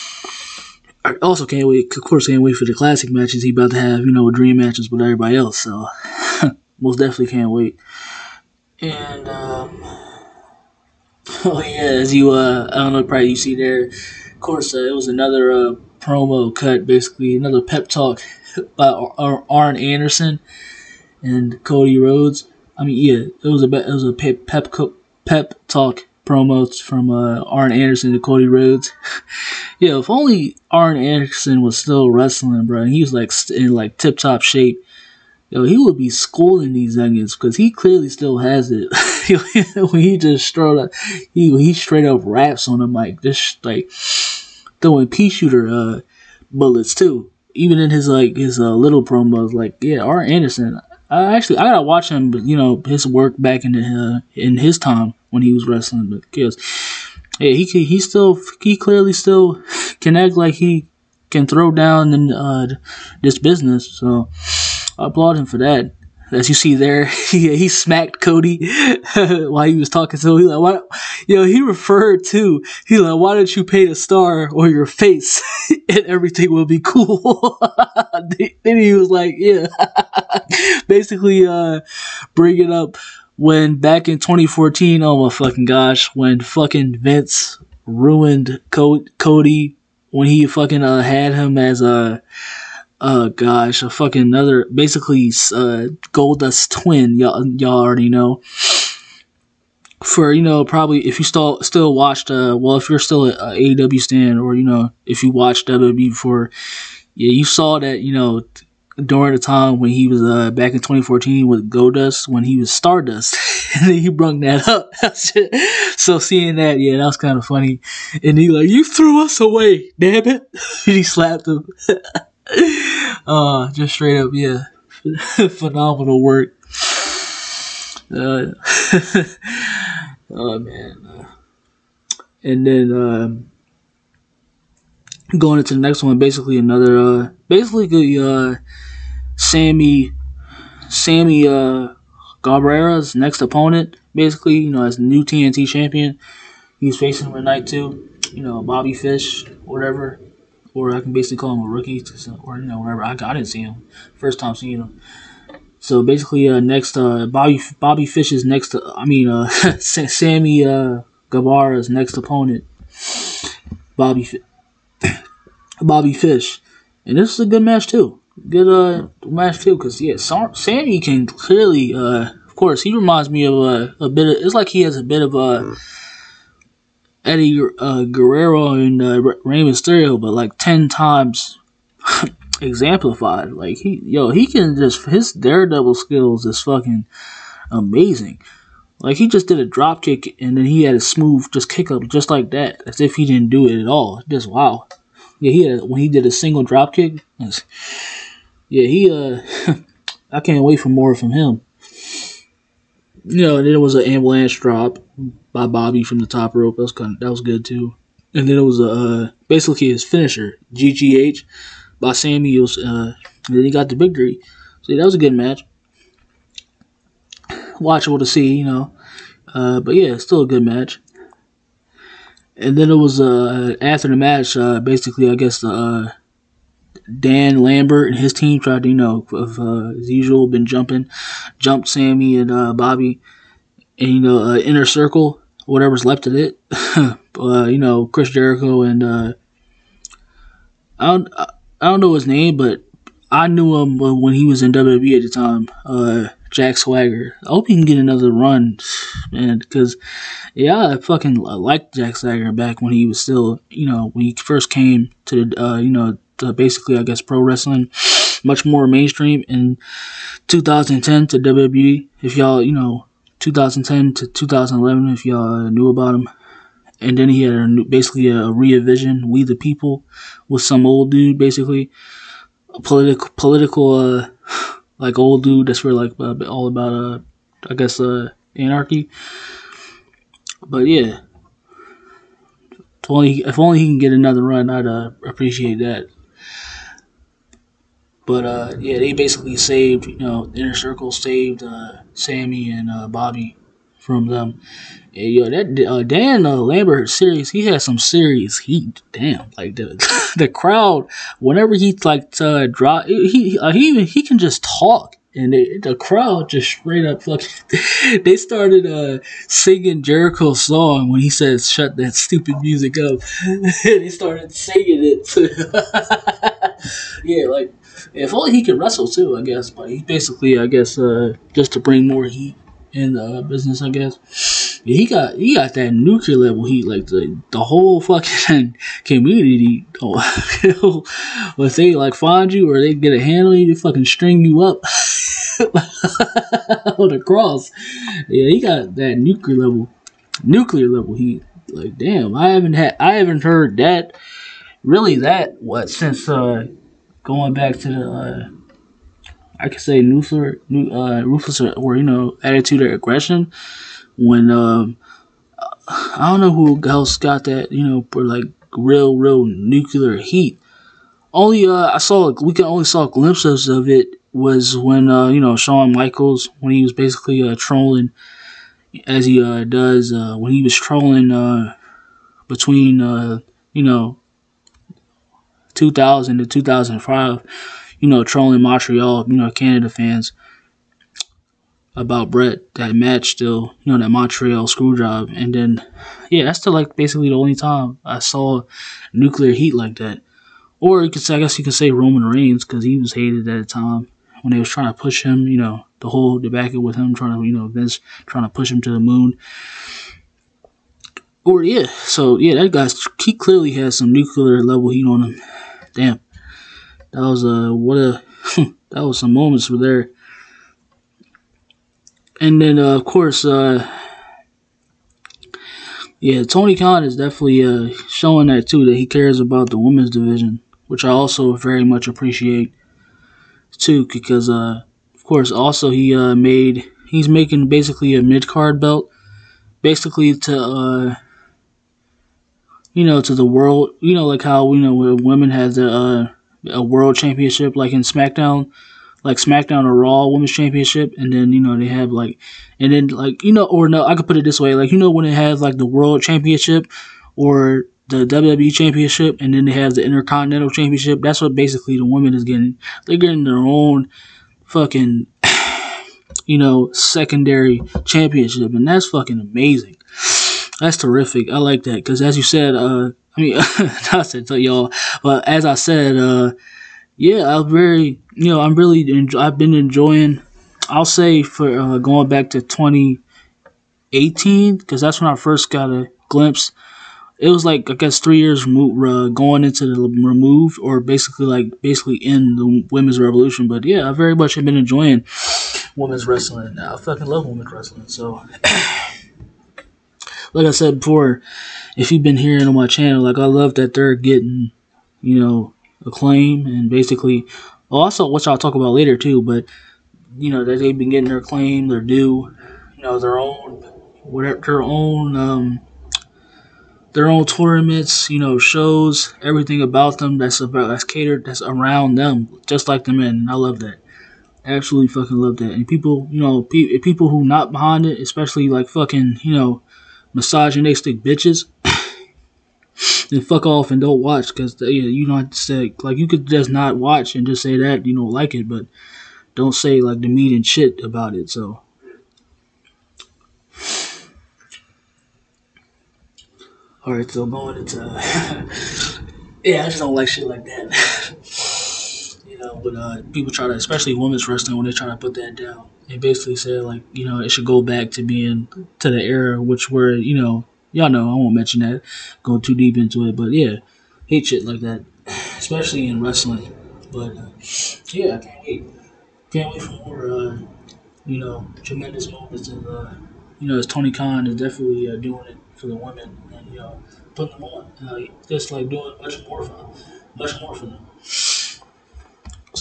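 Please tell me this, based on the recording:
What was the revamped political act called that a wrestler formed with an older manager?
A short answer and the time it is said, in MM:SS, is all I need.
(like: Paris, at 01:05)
We the People, at 04:29.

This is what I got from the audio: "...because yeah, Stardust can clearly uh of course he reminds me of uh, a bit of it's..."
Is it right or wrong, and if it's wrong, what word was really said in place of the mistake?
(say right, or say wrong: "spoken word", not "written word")
wrong: "Sammy", not "Stardust".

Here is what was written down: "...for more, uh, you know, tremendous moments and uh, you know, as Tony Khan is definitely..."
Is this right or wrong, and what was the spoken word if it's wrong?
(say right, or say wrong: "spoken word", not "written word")
right.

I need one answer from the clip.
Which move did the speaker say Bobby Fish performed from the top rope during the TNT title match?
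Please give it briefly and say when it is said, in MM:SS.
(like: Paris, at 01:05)
Ambulance drop, at 03:24.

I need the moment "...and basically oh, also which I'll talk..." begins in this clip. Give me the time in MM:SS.
08:16.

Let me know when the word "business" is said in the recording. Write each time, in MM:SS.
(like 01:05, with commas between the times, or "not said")
01:03, 05:23.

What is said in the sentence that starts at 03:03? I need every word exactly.
Like he yo he can just his daredevil skills is fucking amazing.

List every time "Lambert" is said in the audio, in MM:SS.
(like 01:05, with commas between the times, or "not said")
03:47, 04:56.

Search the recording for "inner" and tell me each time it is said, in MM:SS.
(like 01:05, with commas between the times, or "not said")
03:54, 04:50.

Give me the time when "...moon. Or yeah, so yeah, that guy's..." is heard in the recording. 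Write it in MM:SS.
06:38.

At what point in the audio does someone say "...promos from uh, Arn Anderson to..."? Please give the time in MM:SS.
00:26.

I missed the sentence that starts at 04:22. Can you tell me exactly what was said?
If y'all, you know, 2010 to 2011, if y'all knew about him.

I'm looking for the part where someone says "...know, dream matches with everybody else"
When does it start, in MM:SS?
00:04.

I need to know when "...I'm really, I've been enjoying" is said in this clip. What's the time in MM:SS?
07:48.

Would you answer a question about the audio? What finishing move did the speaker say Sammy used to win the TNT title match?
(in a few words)
GTH.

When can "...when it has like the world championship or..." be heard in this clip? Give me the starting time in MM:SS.
07:25.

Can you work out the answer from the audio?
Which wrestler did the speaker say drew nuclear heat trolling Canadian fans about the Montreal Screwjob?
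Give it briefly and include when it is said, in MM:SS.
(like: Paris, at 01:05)
Shawn Michaels, at 06:05.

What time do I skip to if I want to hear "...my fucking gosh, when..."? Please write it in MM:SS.
01:25.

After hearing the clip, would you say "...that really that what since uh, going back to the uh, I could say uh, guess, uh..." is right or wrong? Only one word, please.
wrong.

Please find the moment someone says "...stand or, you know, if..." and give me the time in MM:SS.
01:43.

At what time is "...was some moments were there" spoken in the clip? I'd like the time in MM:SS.
06:49.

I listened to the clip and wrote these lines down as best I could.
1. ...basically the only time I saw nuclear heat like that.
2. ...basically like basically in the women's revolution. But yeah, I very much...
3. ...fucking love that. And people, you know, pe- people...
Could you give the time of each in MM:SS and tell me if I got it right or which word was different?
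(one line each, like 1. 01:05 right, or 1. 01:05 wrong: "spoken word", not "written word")
1. 06:26 right
2. 08:00 right
3. 08:35 right.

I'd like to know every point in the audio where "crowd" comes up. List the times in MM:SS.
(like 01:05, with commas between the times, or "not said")
05:00, 05:05.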